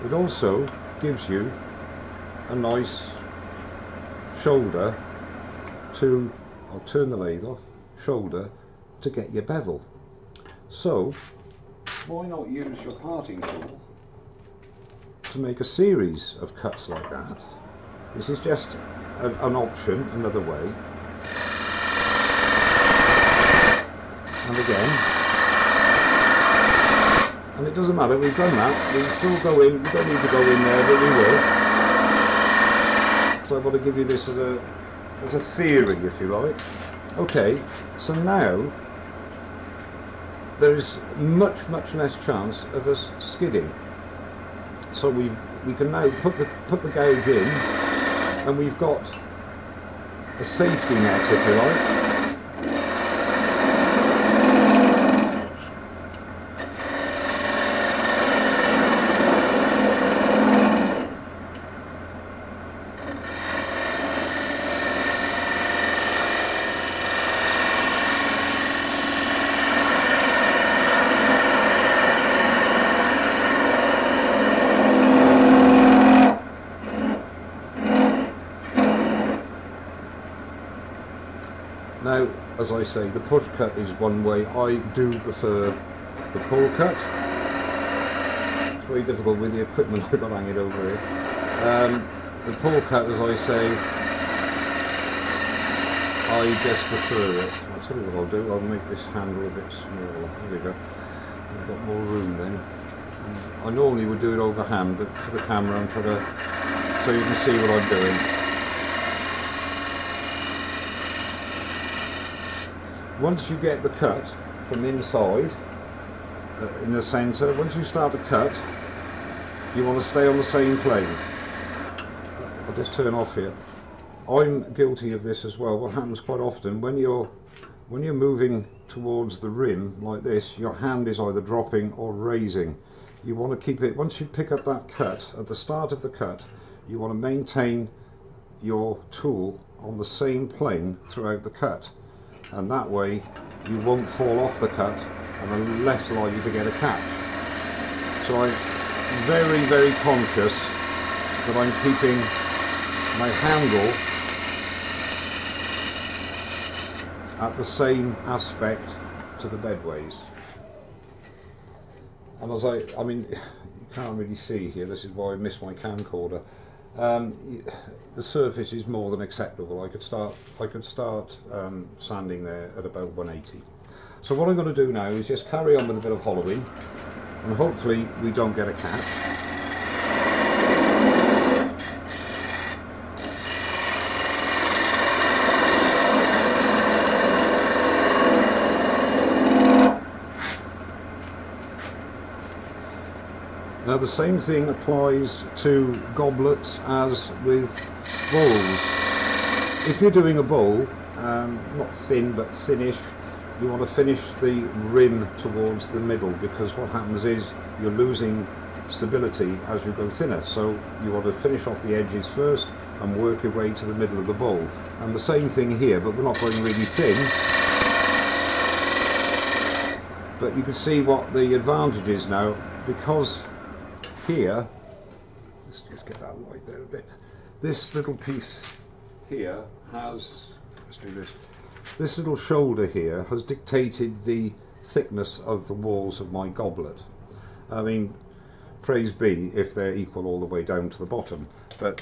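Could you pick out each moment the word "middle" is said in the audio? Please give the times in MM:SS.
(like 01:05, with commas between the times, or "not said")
03:25, 03:33.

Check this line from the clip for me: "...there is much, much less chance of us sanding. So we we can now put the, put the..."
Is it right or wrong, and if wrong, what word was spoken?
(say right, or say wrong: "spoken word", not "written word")
wrong: "skidding", not "sanding".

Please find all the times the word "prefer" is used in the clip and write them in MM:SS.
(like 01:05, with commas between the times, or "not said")
01:25, 01:36.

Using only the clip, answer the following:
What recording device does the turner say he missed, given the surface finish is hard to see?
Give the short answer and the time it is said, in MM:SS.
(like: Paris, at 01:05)
Camcorder, at 02:45.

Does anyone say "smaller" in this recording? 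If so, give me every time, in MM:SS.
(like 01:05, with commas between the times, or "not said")
01:39.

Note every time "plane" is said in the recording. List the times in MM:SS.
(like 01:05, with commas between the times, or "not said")
02:00, 02:20.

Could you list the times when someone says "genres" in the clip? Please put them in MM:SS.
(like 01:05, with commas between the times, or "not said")
not said.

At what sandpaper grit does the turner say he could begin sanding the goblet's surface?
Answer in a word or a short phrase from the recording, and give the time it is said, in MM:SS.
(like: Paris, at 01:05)
180, at 02:53.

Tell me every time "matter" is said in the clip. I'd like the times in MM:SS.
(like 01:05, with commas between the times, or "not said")
00:27.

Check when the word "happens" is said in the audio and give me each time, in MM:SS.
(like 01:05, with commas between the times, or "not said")
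02:05, 03:26.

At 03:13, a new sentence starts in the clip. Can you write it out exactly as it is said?
Now the same thing applies to goblets as with bowls.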